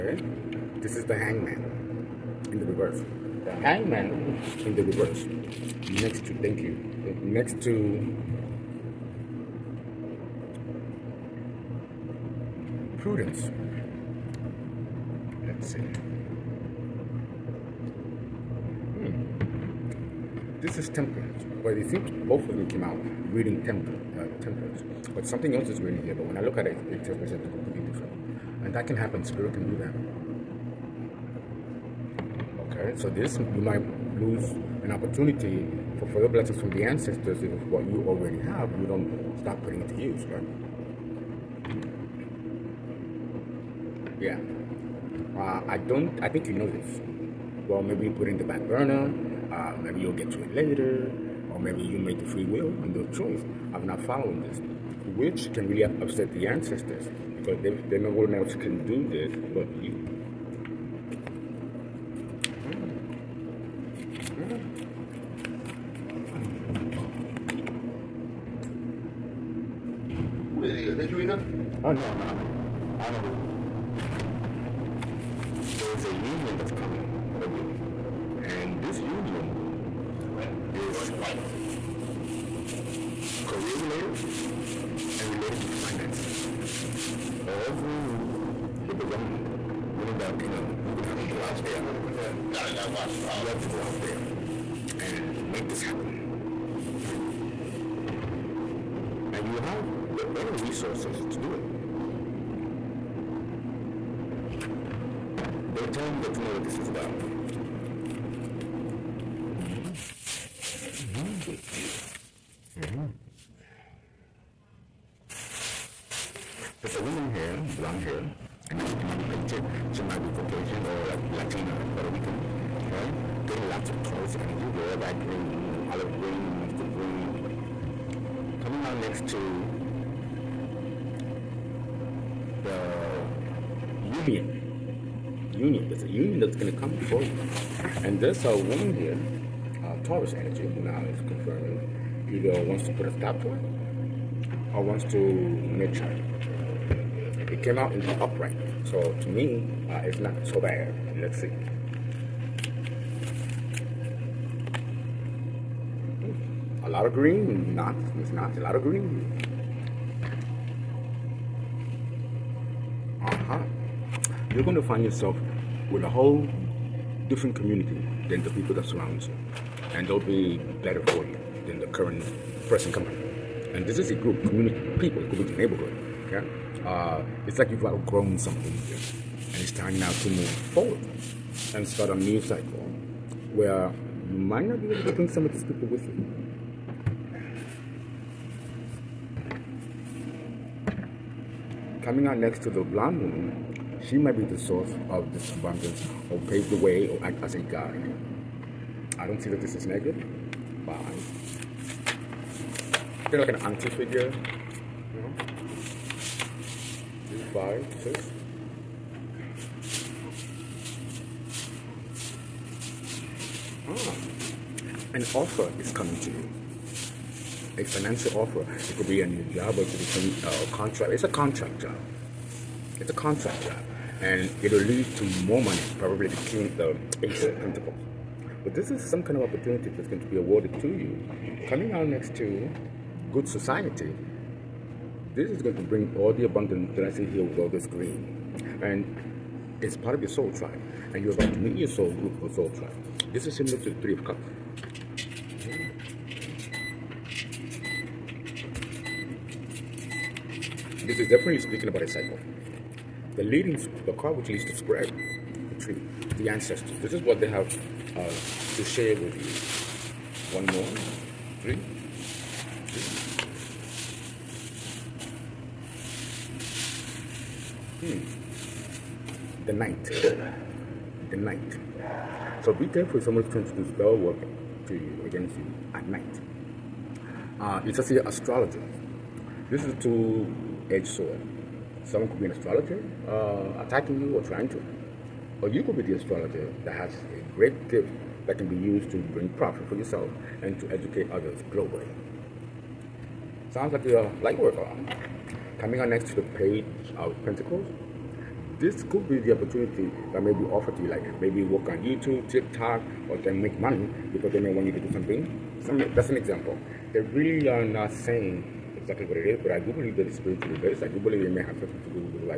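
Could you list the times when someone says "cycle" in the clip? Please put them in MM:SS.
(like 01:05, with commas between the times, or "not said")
03:02, 04:12.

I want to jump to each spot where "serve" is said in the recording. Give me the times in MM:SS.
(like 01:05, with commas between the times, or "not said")
not said.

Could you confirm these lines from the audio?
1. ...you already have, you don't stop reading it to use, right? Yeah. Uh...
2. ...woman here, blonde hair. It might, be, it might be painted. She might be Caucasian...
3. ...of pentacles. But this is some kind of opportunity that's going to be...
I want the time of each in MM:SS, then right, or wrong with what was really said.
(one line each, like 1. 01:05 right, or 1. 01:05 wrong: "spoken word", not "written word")
1. 00:37 wrong: "putting", not "reading"
2. 01:57 right
3. 03:47 right.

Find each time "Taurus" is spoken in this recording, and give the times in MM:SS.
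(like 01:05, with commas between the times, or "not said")
02:04, 02:20.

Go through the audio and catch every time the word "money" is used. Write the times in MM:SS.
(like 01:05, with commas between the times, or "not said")
03:45, 05:03.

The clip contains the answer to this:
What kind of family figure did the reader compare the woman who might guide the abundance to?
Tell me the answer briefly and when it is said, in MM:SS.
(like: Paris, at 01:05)
An auntie figure, at 03:23.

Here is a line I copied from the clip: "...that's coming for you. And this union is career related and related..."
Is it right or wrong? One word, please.
right.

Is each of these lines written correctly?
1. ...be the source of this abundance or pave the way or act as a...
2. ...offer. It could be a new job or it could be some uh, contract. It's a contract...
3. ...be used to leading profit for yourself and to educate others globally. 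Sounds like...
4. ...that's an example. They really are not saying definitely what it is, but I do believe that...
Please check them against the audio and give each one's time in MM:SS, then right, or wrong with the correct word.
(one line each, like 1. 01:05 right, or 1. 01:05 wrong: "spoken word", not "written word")
1. 03:14 right
2. 03:38 right
3. 04:48 wrong: "bring", not "leading"
4. 05:06 wrong: "exactly", not "definitely".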